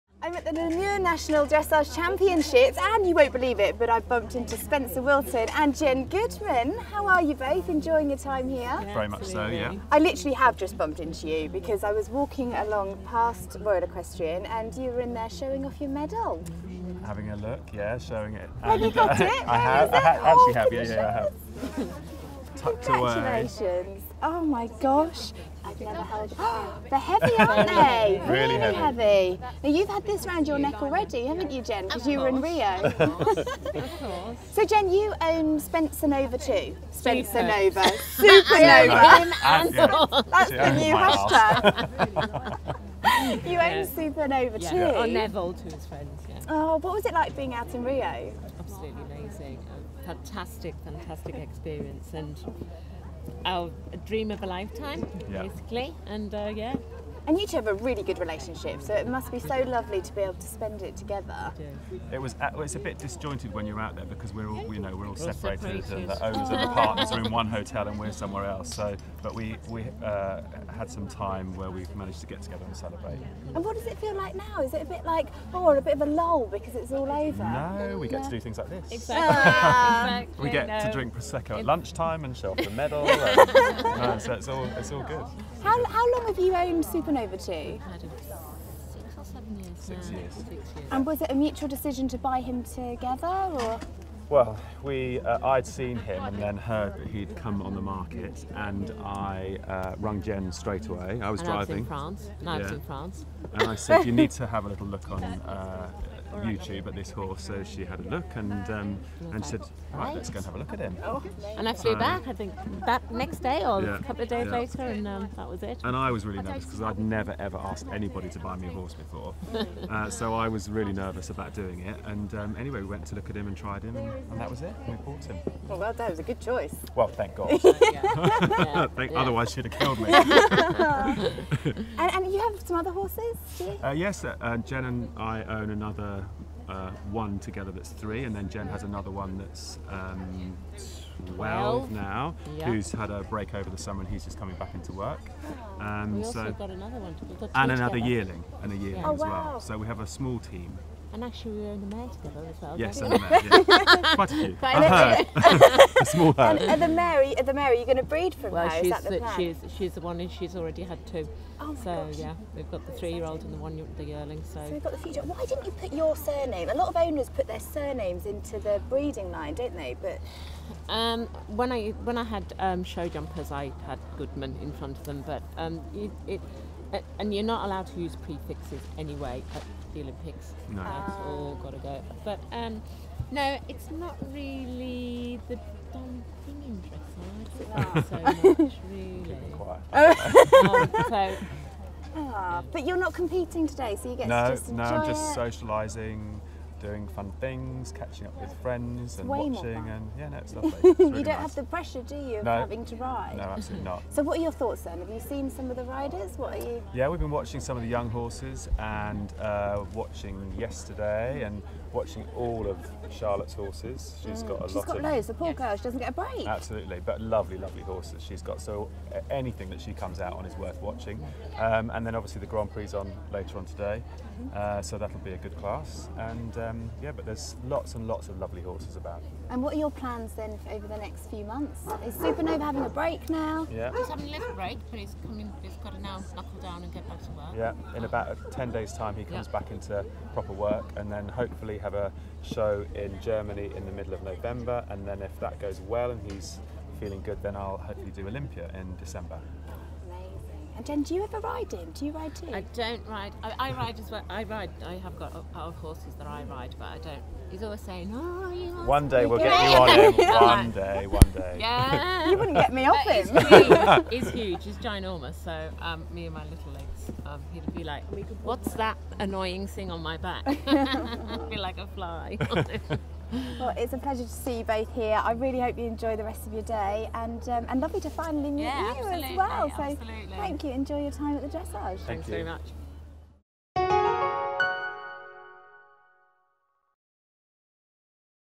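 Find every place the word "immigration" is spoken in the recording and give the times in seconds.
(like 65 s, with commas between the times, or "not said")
not said.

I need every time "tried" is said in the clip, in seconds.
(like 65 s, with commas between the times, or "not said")
123 s.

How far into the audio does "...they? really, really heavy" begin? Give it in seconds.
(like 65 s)
27 s.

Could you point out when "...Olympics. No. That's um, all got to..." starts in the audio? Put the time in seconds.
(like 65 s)
180 s.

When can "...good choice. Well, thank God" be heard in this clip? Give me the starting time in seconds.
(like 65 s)
126 s.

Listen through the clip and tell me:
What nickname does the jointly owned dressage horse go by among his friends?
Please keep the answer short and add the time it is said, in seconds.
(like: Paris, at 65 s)
Neville, at 44 s.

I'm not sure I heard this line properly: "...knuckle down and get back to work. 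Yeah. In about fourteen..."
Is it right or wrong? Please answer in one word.
wrong.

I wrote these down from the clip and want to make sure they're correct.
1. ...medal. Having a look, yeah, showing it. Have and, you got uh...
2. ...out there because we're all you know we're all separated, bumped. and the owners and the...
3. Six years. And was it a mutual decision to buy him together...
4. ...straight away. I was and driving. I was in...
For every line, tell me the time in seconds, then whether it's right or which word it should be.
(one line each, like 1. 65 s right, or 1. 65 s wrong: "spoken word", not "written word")
1. 15 s right
2. 63 s wrong: "separated", not "bumped"
3. 90 s right
4. 100 s right.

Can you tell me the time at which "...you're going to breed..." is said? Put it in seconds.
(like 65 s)
157 s.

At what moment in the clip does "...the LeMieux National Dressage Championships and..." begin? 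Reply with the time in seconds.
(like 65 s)
0 s.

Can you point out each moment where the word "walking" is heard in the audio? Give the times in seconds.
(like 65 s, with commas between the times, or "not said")
12 s.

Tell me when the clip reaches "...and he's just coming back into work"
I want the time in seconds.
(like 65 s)
144 s.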